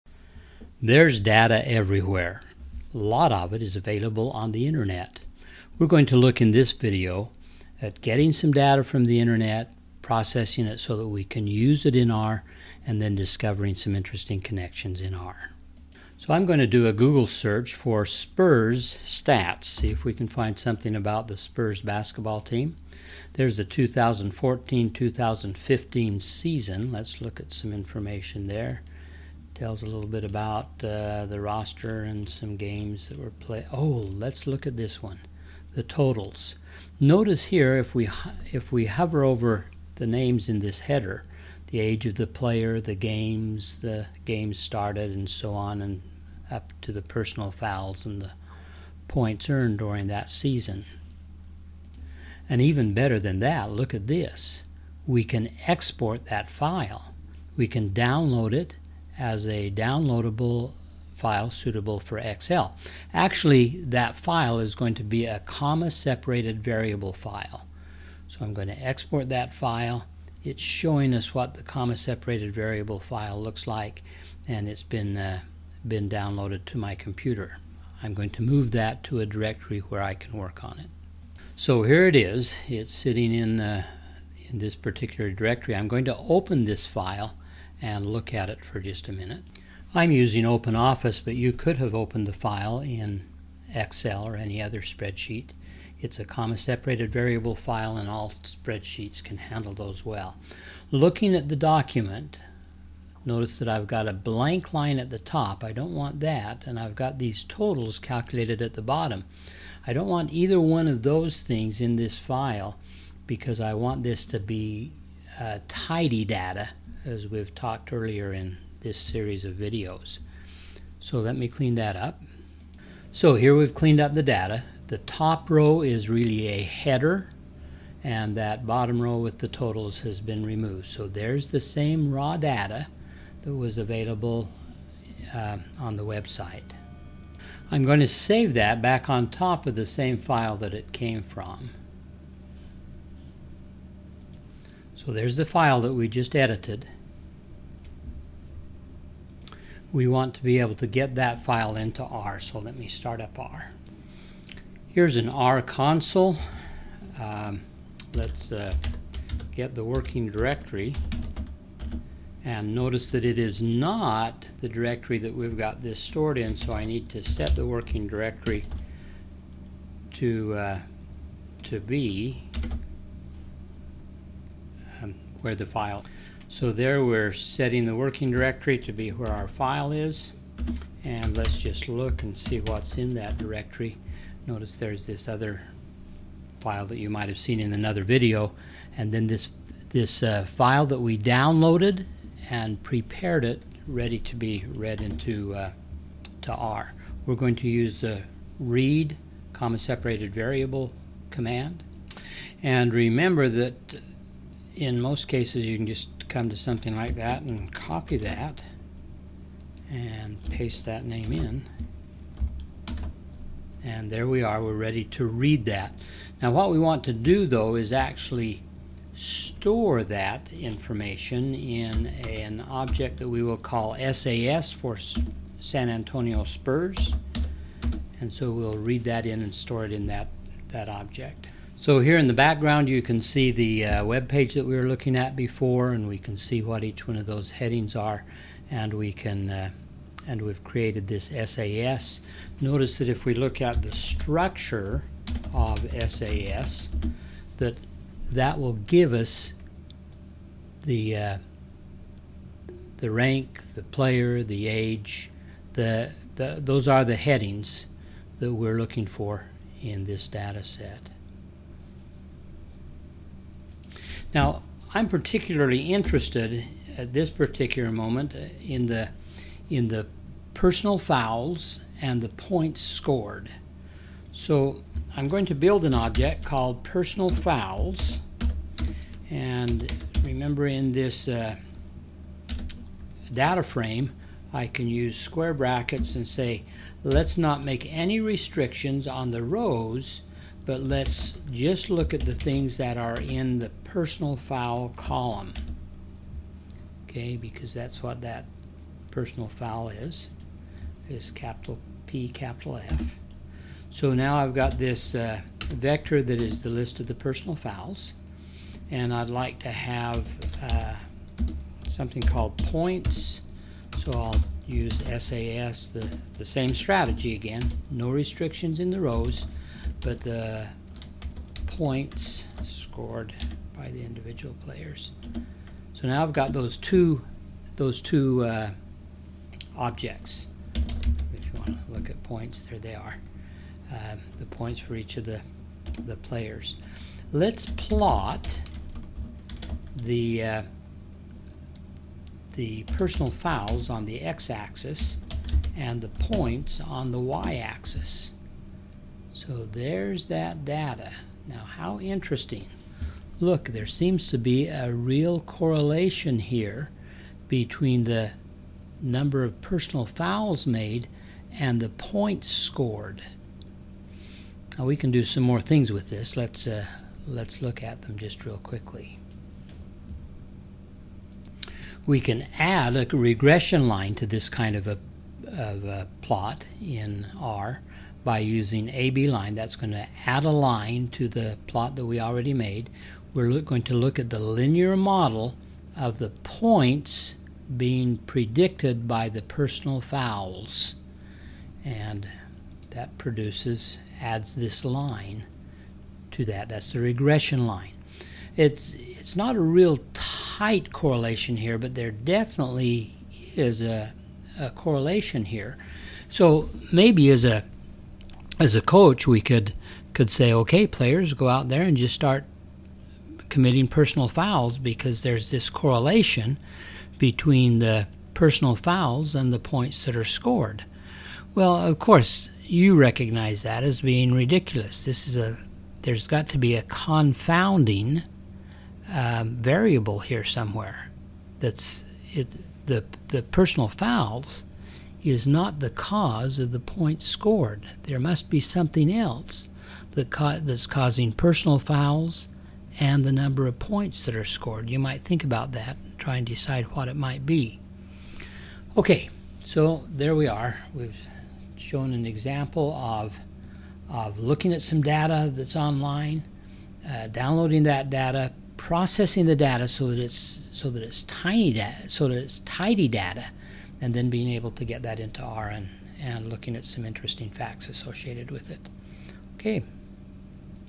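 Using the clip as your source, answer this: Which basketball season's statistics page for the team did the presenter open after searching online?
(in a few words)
2014-2015.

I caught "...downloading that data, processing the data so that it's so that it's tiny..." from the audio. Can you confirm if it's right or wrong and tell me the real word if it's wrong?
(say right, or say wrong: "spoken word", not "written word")
right.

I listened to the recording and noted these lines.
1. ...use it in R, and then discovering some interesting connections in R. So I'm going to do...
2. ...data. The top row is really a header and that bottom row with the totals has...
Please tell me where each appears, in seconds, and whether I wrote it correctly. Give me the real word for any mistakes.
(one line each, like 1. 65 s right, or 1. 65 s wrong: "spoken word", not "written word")
1. 11 s right
2. 124 s right.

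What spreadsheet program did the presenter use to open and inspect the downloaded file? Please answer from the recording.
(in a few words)
OpenOffice.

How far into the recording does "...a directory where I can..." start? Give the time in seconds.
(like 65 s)
79 s.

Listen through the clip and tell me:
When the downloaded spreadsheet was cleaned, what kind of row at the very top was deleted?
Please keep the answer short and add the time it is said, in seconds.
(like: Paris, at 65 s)
blank line, at 104 s.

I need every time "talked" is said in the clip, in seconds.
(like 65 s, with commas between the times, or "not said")
117 s.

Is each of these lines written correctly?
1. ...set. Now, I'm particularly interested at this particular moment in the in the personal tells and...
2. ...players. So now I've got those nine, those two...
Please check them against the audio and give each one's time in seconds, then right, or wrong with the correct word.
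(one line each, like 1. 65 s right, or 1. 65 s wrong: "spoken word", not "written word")
1. 260 s wrong: "fouls", not "tells"
2. 324 s wrong: "two", not "nine".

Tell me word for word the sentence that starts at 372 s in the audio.
We can add a regression line to this kind of a, of a plot in R by using AB line.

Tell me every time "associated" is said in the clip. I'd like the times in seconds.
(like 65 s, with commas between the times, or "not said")
467 s.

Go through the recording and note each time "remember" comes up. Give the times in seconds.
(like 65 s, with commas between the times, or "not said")
202 s, 280 s.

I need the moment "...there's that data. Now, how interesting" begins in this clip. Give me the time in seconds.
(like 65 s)
349 s.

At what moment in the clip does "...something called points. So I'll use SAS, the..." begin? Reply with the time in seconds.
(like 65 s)
311 s.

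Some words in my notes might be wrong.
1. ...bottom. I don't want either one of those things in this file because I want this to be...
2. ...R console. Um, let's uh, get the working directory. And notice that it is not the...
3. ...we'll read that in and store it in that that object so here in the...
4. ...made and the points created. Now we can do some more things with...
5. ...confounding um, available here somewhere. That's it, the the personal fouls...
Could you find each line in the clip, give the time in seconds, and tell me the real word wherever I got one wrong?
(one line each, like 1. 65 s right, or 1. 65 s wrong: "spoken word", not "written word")
1. 108 s right
2. 155 s right
3. 228 s right
4. 360 s wrong: "scored", not "created"
5. 426 s wrong: "variable", not "available".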